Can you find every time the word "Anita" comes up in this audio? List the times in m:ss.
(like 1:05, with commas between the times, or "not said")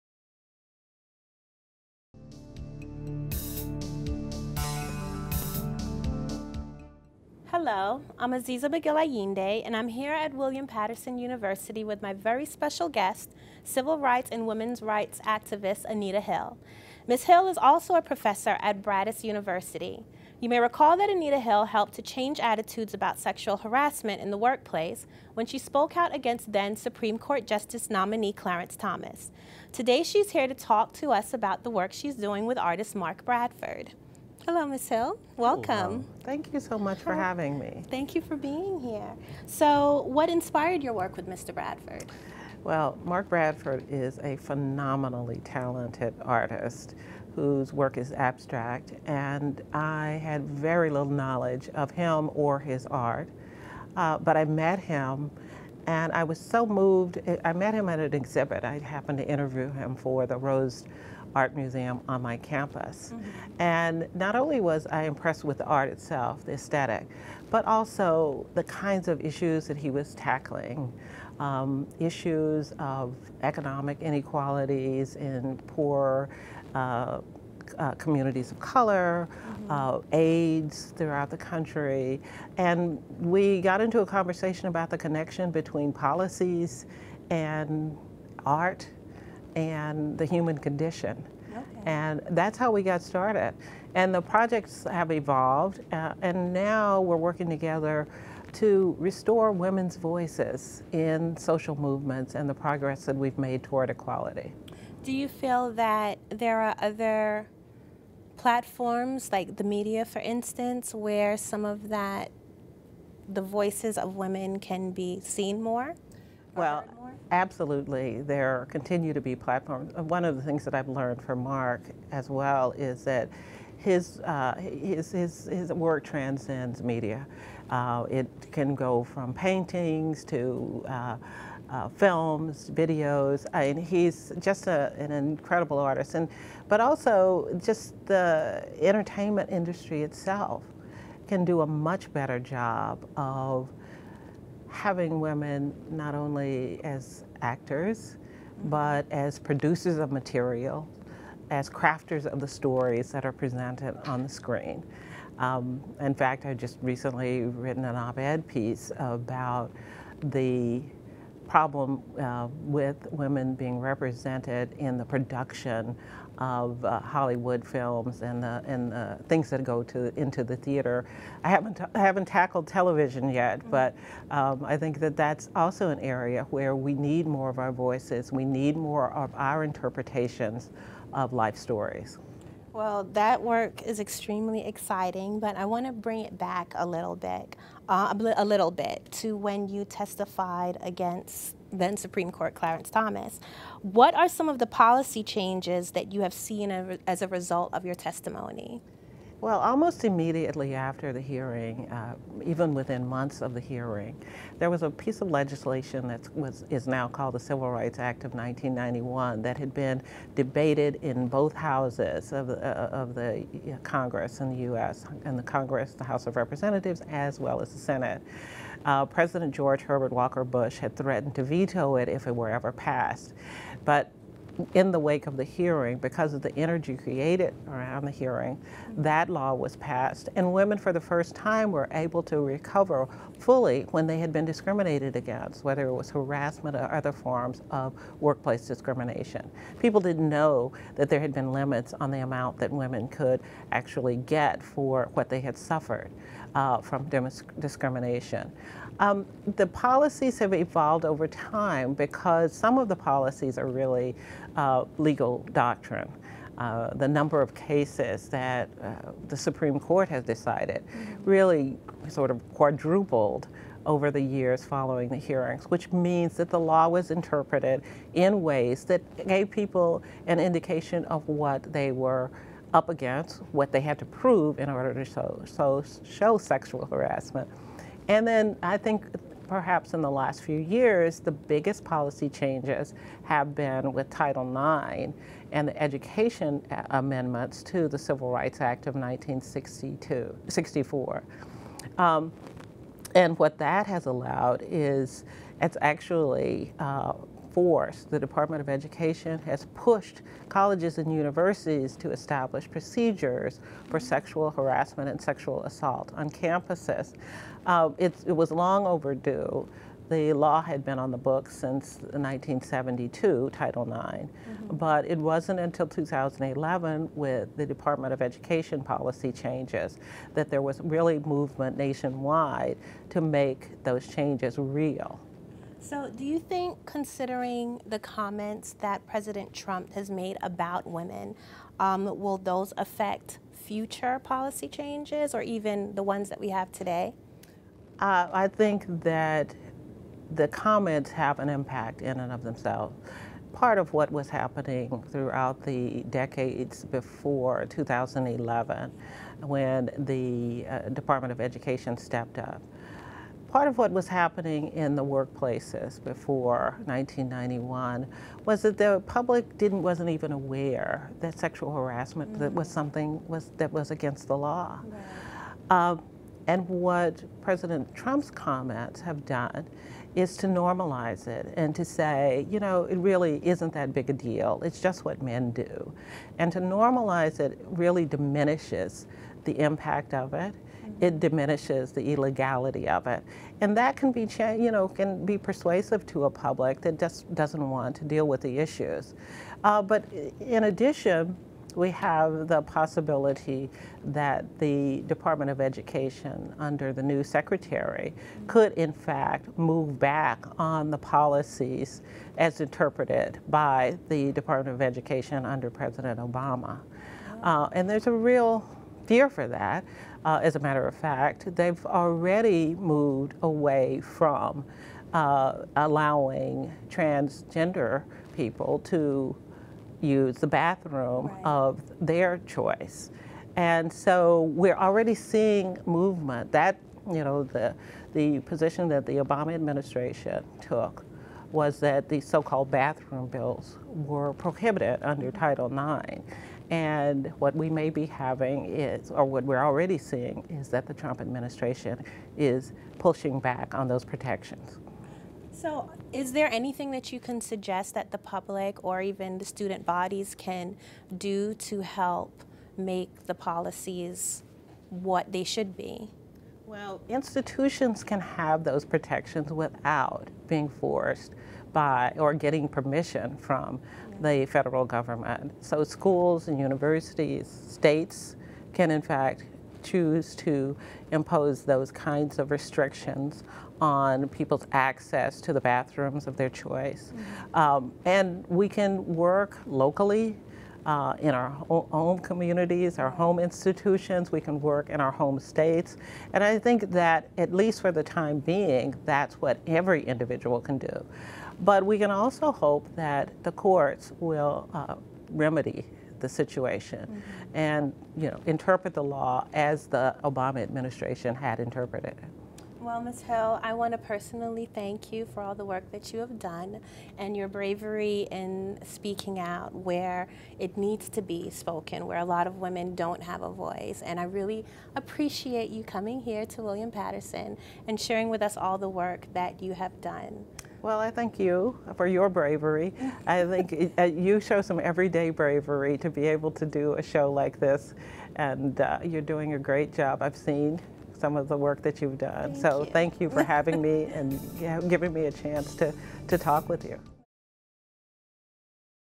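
0:15, 0:21.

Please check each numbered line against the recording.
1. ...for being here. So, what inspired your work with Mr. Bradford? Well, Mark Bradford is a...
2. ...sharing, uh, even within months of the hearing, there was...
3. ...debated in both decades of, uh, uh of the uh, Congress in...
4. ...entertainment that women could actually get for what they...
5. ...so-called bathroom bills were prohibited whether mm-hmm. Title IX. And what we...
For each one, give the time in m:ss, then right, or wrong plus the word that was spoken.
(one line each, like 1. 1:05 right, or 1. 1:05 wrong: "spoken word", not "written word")
1. 0:38 right
2. 3:21 wrong: "hearing", not "sharing"
3. 3:30 wrong: "houses", not "decades"
4. 4:02 wrong: "amount", not "entertainment"
5. 7:12 wrong: "under", not "whether".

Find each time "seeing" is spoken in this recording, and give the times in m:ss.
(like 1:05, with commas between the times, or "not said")
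7:05, 7:19.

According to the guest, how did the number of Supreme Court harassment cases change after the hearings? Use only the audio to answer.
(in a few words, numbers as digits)
quadrupled.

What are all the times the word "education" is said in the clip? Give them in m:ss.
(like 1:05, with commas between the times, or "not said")
4:45, 4:58, 5:18, 5:51, 6:35, 6:44.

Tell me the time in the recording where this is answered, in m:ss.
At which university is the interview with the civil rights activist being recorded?
0:10.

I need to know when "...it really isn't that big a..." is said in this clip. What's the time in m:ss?
6:12.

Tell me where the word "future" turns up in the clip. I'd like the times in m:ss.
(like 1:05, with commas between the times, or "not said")
5:33.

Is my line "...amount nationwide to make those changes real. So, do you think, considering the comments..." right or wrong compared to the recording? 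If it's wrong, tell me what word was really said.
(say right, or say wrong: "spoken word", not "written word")
wrong: "movement", not "amount".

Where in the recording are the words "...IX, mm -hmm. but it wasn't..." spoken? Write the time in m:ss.
5:13.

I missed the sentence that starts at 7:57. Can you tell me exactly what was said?
um, and we can work locally uh, in our home communities, our home institutions, we can work in our home states.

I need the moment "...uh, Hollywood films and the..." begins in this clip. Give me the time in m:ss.
2:46.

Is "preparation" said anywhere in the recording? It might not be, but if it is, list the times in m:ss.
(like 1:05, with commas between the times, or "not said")
not said.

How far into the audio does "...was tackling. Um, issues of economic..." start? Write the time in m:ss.
1:09.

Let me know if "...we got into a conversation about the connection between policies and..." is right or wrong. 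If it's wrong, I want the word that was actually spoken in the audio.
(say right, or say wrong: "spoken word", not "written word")
right.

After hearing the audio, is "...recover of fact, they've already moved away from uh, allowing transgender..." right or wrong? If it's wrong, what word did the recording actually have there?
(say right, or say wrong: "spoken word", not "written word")
wrong: "matter", not "recover".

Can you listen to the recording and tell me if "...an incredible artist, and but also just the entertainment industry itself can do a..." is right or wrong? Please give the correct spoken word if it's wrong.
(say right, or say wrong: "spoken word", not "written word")
right.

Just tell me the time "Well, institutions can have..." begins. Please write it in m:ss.
7:36.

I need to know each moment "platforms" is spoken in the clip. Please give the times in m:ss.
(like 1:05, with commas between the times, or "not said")
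1:48, 1:59.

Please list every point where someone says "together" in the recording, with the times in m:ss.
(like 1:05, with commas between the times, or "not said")
1:37.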